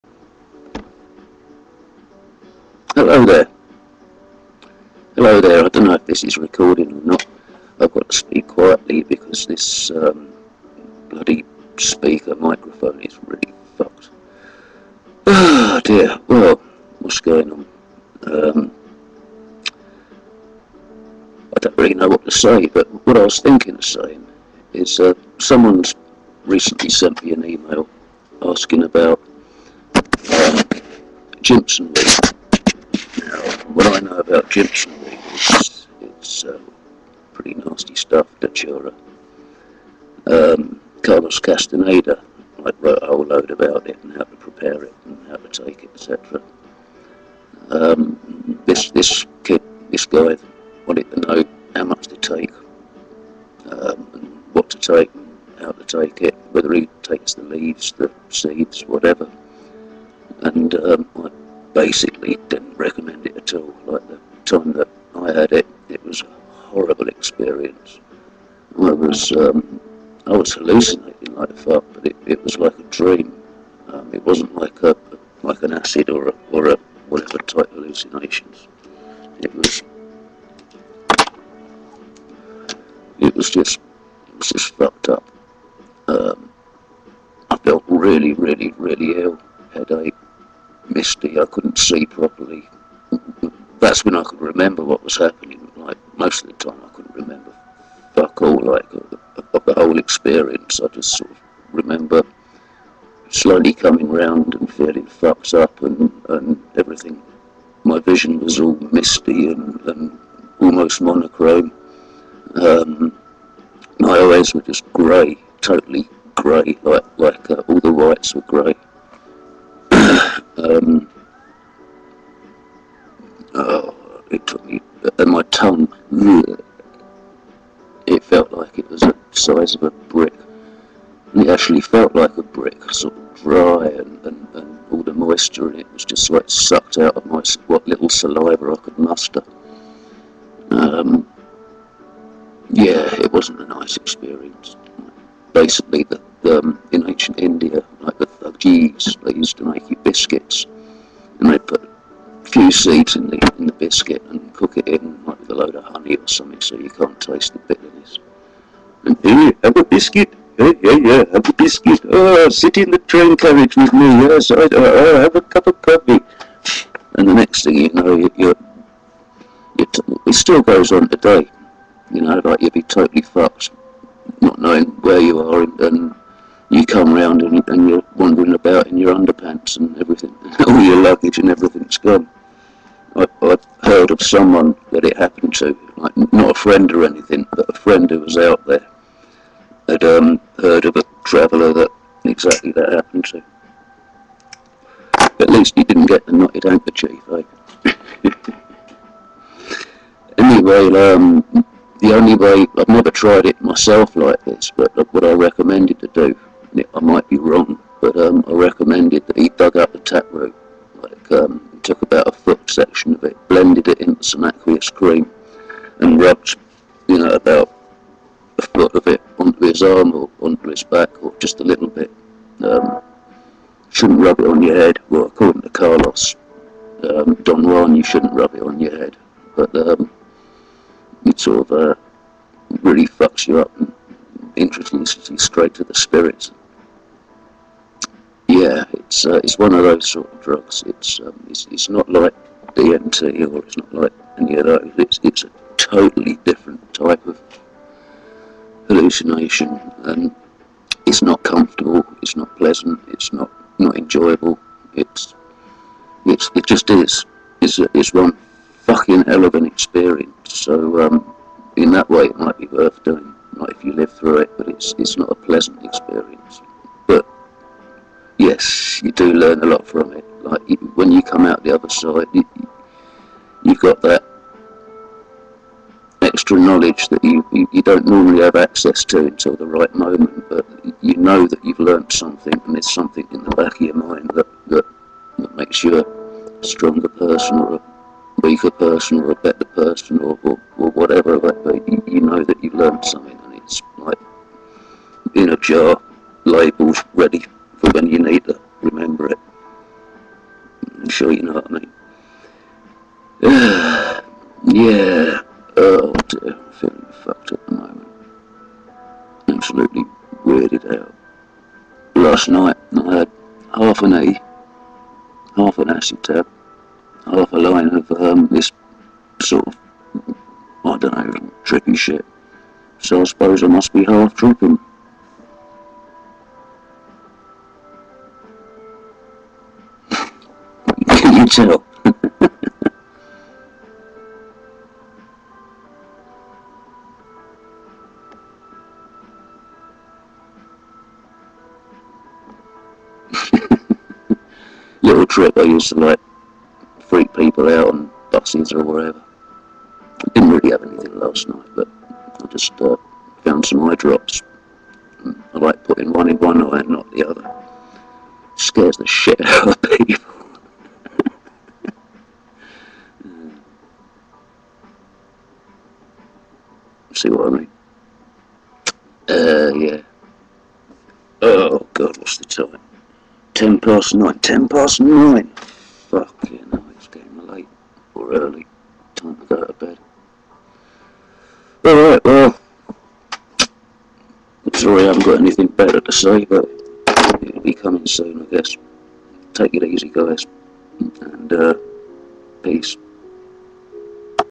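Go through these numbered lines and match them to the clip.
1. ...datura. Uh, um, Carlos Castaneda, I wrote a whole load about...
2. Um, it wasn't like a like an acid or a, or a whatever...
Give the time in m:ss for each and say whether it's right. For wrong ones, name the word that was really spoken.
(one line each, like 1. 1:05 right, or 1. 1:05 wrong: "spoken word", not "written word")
1. 0:38 right
2. 1:13 right.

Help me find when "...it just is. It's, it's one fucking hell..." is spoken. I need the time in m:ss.
4:16.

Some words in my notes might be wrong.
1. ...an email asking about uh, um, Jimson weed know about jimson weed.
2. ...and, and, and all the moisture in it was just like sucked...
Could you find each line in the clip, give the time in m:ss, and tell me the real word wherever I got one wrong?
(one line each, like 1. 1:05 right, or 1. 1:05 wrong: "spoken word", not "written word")
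1. 0:27 right
2. 2:13 right.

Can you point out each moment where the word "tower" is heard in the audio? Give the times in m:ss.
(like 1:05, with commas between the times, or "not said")
not said.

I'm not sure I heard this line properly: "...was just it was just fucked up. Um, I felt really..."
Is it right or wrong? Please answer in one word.
right.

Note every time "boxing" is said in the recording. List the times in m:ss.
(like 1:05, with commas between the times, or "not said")
not said.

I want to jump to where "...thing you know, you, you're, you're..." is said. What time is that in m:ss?
2:47.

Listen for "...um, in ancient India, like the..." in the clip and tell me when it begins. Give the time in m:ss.
2:26.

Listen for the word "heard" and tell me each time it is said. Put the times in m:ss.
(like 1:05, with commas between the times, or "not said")
3:03, 3:10.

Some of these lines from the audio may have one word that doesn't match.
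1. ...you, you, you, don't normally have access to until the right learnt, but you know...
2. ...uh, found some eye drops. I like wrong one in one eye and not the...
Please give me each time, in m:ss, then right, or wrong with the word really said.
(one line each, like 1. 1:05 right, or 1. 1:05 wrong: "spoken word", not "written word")
1. 4:37 wrong: "moment", not "learnt"
2. 5:52 wrong: "putting", not "wrong".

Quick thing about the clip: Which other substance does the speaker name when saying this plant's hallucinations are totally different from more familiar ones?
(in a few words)
DMT.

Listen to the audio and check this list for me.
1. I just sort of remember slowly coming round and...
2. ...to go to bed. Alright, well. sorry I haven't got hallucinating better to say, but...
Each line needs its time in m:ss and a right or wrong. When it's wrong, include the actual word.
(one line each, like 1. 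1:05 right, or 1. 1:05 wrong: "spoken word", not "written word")
1. 1:40 right
2. 6:19 wrong: "anything", not "hallucinating".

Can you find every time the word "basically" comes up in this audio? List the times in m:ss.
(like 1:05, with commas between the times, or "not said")
1:01, 2:25.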